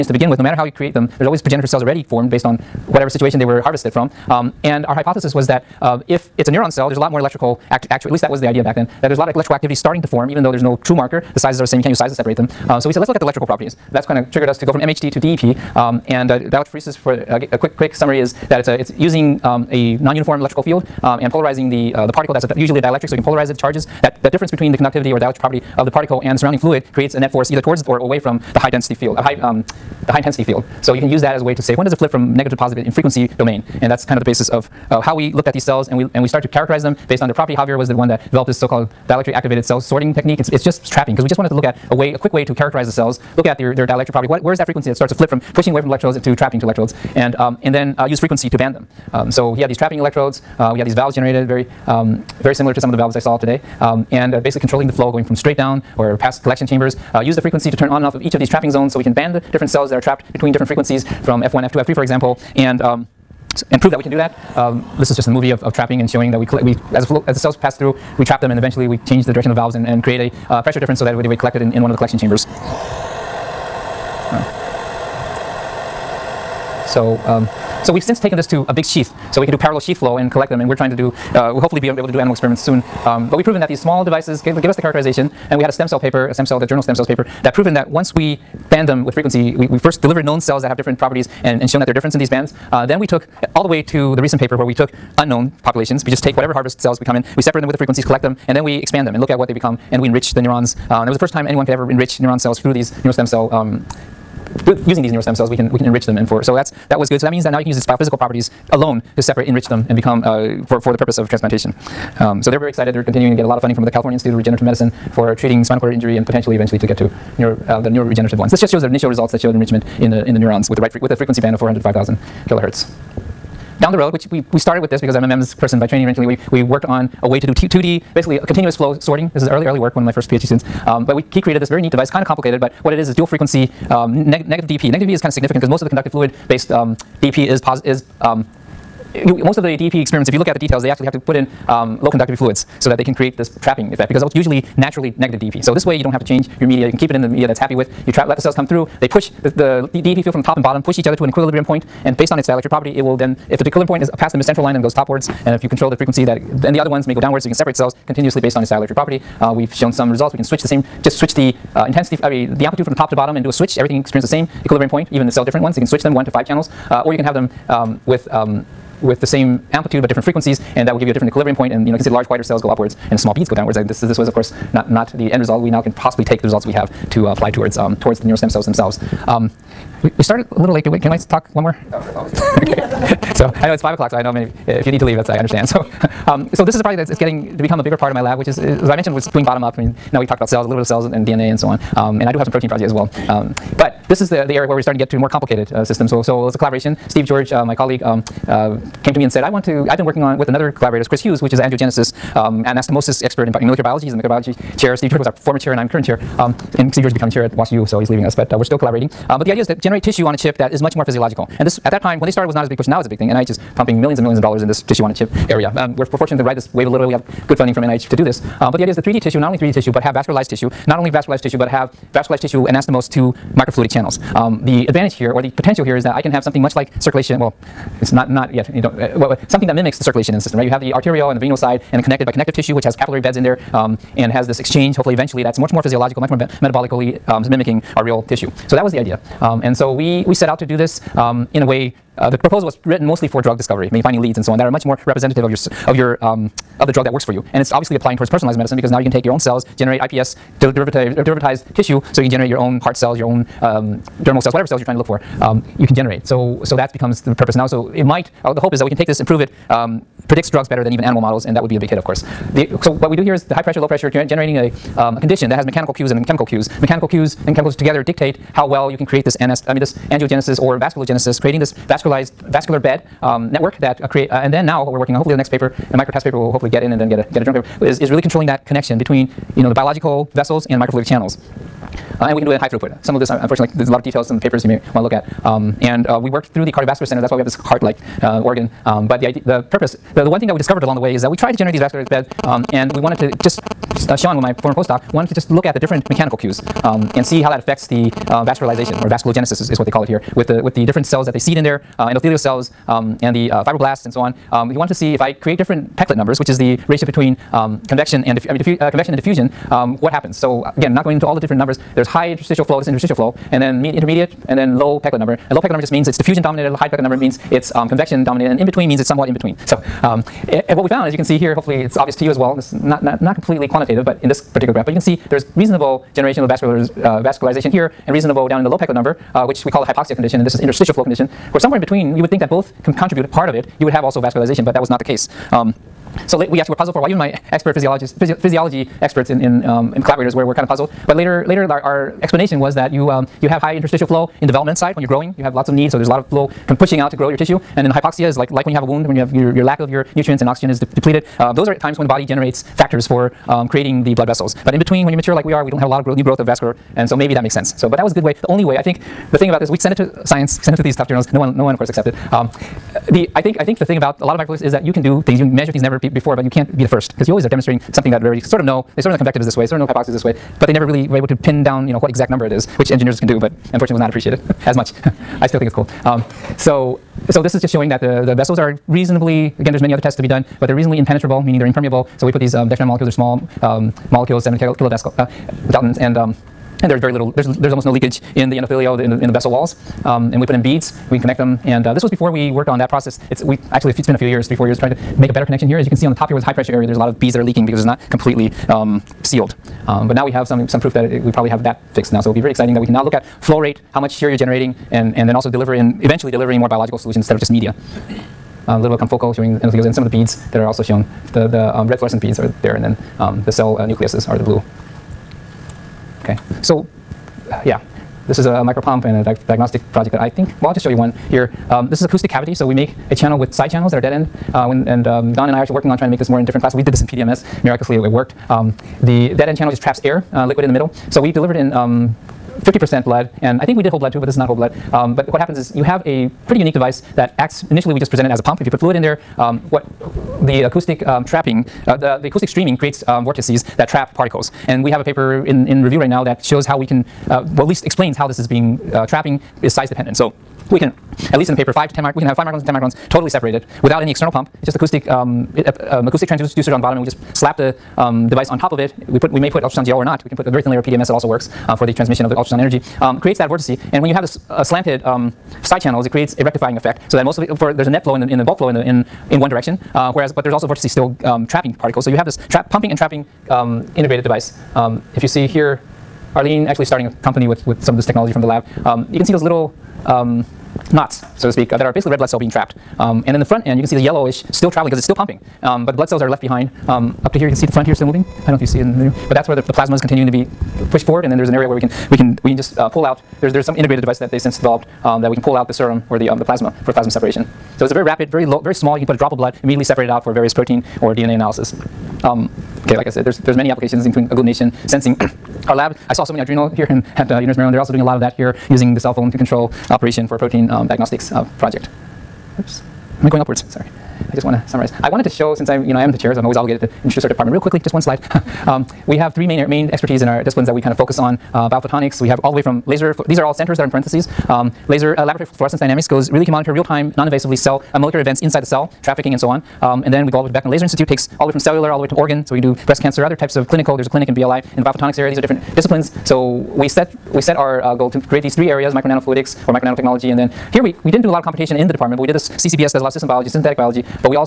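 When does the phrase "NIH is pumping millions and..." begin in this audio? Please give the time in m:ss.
3:33.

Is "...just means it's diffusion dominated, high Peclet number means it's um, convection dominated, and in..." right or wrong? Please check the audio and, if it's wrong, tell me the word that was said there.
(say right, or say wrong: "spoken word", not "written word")
right.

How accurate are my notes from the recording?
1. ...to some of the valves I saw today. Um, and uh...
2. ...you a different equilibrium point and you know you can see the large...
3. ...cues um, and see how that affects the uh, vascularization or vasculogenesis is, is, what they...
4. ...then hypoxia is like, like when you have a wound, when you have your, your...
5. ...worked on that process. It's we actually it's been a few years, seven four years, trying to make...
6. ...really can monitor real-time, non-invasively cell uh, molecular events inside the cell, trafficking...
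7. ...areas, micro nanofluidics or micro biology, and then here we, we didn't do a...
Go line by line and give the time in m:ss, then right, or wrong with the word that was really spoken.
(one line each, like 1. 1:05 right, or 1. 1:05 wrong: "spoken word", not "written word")
1. 0:52 right
2. 2:51 right
3. 4:56 right
4. 5:47 right
5. 6:32 wrong: "three", not "seven"
6. 8:46 right
7. 8:58 wrong: "nanotechnology", not "biology".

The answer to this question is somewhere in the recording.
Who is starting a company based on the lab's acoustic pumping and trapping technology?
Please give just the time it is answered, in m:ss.
7:56.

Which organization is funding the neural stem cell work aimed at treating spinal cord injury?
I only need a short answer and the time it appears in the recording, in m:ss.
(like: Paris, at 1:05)
California Institute of Regenerative Medicine, at 1:53.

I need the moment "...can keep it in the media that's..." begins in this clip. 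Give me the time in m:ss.
2:26.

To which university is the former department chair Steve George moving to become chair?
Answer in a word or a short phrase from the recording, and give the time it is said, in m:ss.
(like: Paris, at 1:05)
WashU, at 3:27.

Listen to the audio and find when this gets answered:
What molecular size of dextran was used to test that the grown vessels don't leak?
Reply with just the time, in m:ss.
6:24.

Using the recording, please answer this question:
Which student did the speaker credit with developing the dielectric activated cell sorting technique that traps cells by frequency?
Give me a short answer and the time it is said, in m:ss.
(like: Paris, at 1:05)
Javier, at 0:37.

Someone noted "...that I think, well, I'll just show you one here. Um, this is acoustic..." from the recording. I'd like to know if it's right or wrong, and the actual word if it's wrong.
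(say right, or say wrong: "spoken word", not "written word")
right.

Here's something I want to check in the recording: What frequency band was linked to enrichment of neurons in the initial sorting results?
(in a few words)
400 to 5,000 kilohertz.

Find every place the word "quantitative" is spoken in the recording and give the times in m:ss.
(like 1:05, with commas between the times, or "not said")
5:23.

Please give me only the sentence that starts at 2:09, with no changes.
This is early, early work, one of my first PhD students.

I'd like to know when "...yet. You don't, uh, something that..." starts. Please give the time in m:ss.
3:48.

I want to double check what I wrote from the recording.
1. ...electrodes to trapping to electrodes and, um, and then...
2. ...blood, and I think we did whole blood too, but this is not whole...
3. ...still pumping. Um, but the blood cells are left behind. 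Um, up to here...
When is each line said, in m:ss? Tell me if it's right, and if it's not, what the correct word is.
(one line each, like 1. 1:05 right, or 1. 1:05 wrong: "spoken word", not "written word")
1. 0:45 right
2. 7:13 right
3. 8:05 right.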